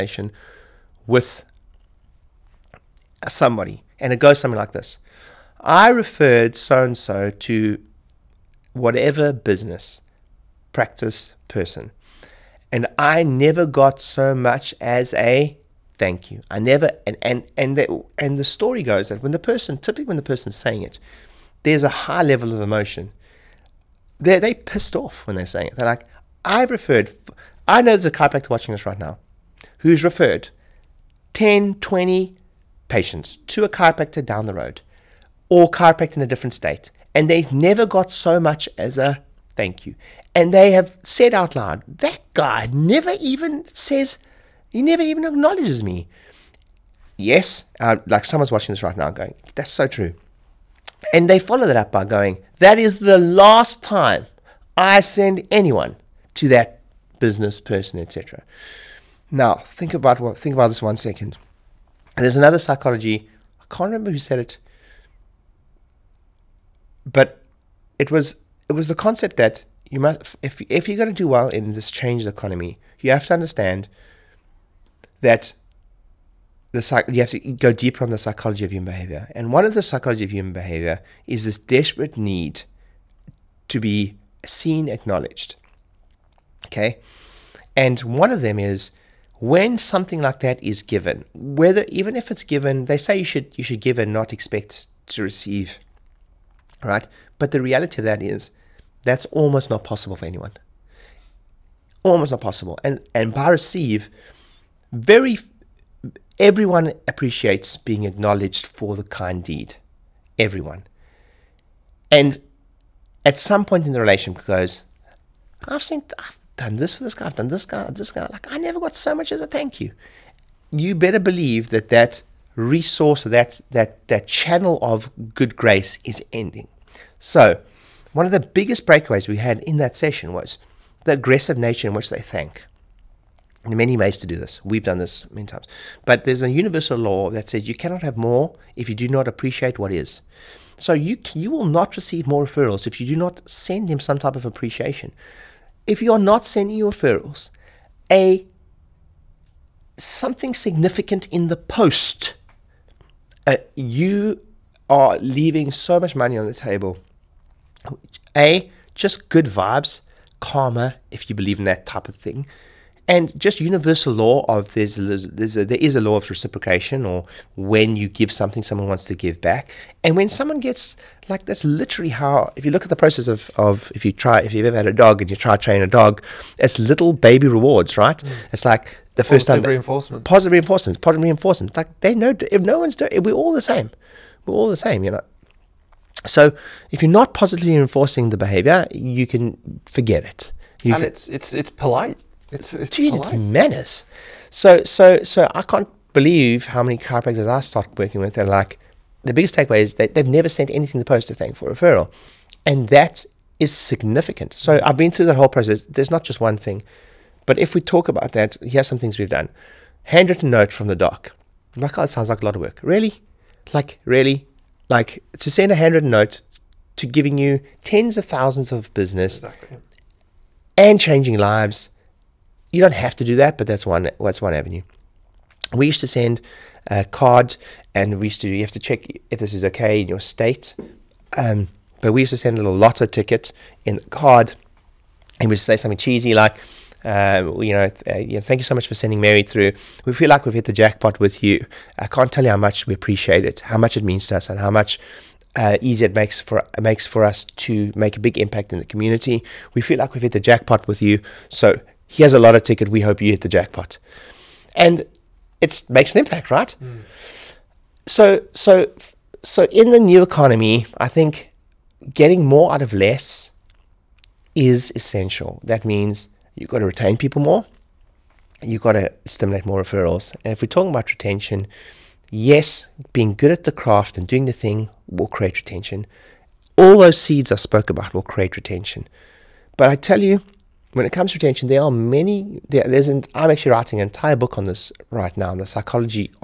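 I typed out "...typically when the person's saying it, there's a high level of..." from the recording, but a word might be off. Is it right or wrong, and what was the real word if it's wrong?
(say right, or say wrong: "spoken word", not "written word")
right.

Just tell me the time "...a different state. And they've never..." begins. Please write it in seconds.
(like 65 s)
36 s.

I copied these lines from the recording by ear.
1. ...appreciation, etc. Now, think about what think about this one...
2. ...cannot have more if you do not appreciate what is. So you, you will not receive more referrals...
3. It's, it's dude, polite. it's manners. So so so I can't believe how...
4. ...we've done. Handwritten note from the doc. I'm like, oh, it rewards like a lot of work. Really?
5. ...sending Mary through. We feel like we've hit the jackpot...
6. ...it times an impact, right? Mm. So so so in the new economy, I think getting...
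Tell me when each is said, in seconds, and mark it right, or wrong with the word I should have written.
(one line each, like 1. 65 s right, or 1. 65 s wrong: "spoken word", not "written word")
1. 57 s wrong: "person", not "appreciation"
2. 137 s right
3. 192 s right
4. 209 s wrong: "sounds", not "rewards"
5. 238 s right
6. 255 s wrong: "makes", not "times".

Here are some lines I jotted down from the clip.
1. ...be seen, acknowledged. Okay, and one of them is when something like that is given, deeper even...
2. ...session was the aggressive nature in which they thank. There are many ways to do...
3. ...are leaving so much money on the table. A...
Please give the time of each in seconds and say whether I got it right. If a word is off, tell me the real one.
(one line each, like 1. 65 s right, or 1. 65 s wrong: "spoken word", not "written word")
1. 83 s wrong: "whether", not "deeper"
2. 129 s right
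3. 154 s right.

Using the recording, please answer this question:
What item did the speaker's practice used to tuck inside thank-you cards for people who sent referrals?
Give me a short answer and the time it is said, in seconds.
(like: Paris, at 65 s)
lotto ticket, at 232 s.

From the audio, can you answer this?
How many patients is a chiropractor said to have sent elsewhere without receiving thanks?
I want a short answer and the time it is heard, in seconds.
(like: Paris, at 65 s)
10, 20, at 31 s.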